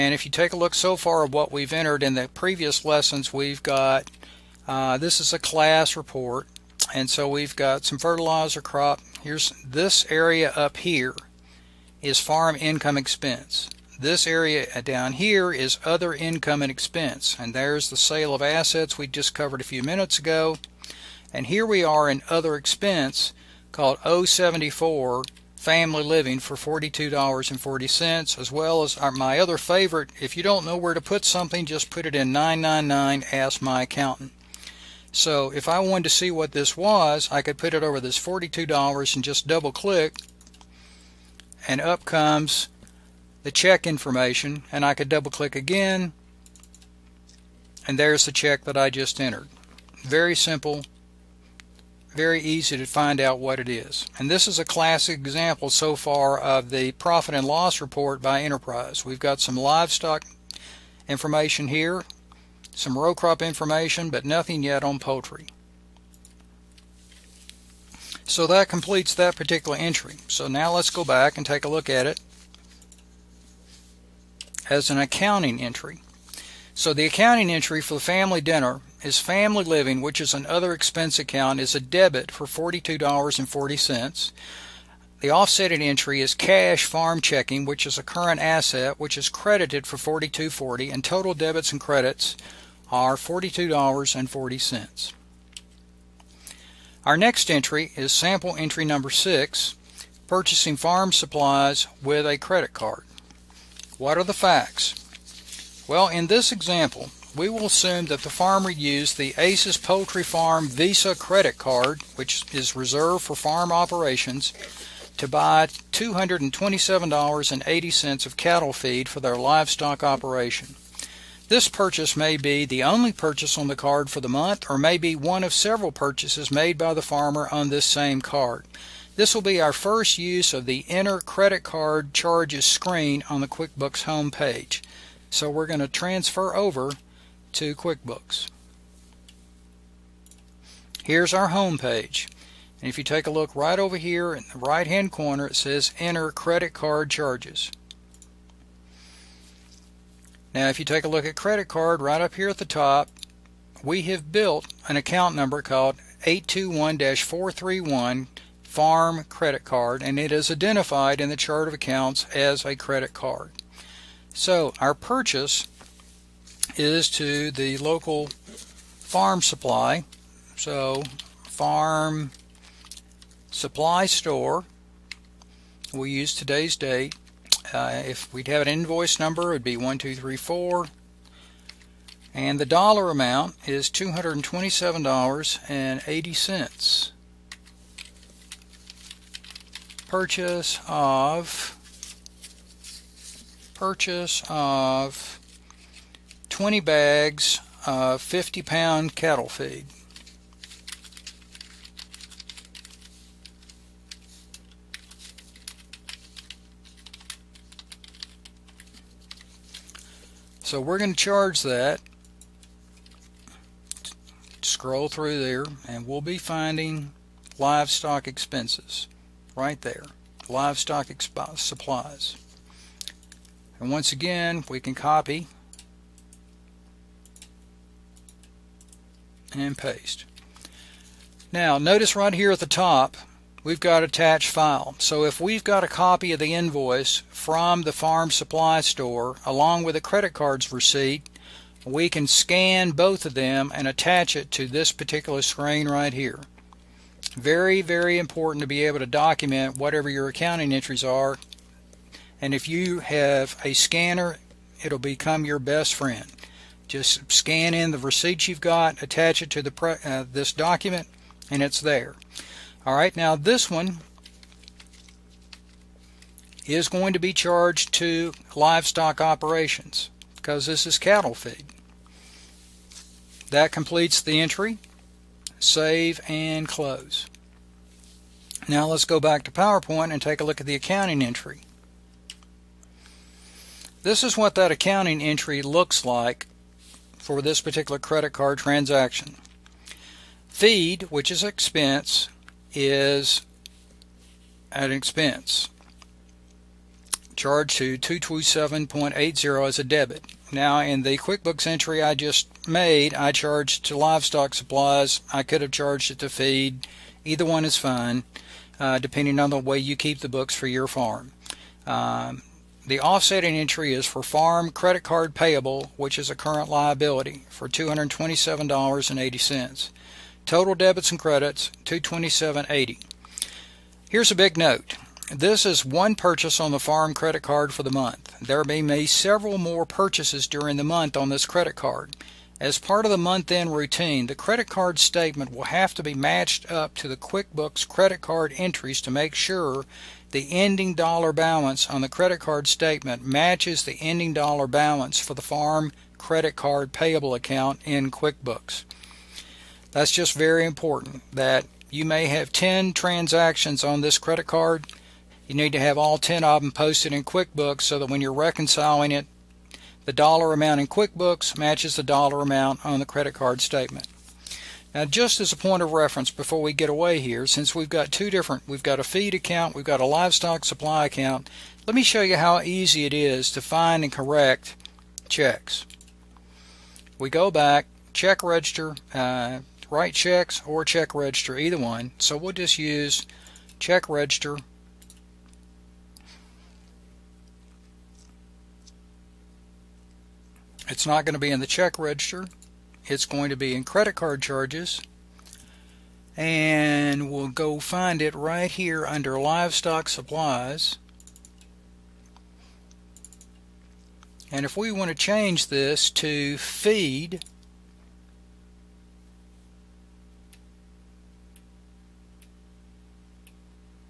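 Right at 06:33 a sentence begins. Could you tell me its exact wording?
It's going to be in credit card charges.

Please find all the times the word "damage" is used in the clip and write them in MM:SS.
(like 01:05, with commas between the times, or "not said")
not said.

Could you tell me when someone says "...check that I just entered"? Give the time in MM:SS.
00:48.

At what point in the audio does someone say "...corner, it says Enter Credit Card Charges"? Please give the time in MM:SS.
02:25.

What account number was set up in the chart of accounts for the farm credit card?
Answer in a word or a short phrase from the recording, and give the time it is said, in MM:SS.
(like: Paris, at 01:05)
821 431, at 02:36.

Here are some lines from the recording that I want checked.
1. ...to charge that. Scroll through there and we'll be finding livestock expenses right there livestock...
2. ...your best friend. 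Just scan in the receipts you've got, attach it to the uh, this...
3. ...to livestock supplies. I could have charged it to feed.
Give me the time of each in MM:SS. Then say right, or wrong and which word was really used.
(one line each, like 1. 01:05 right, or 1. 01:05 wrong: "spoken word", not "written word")
1. 03:31 right
2. 04:15 right
3. 05:03 right.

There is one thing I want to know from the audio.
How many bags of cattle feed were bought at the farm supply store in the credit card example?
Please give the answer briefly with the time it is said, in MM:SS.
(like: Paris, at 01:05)
20, at 03:16.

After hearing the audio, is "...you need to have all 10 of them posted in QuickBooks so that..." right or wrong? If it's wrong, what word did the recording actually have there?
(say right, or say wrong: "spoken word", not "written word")
right.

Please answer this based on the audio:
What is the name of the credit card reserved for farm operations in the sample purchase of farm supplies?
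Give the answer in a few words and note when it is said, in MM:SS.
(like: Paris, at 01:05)
ACES Poultry Farm Visa, at 01:49.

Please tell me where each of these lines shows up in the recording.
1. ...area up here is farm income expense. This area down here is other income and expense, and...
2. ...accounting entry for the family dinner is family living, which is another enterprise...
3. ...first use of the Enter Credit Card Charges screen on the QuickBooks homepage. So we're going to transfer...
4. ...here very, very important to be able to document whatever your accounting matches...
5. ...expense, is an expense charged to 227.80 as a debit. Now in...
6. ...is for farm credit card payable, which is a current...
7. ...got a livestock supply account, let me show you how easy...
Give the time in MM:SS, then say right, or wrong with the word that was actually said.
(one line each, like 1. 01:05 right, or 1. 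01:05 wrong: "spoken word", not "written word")
1. 00:10 right
2. 01:17 wrong: "expense", not "enterprise"
3. 02:09 right
4. 04:06 wrong: "entries", not "matches"
5. 04:51 right
6. 05:13 right
7. 06:09 right.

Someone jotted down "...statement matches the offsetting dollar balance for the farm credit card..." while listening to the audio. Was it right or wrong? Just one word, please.
wrong.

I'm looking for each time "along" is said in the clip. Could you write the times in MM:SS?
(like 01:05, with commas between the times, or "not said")
03:59.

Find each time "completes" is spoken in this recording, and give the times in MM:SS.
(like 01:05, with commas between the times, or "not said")
01:08, 04:33.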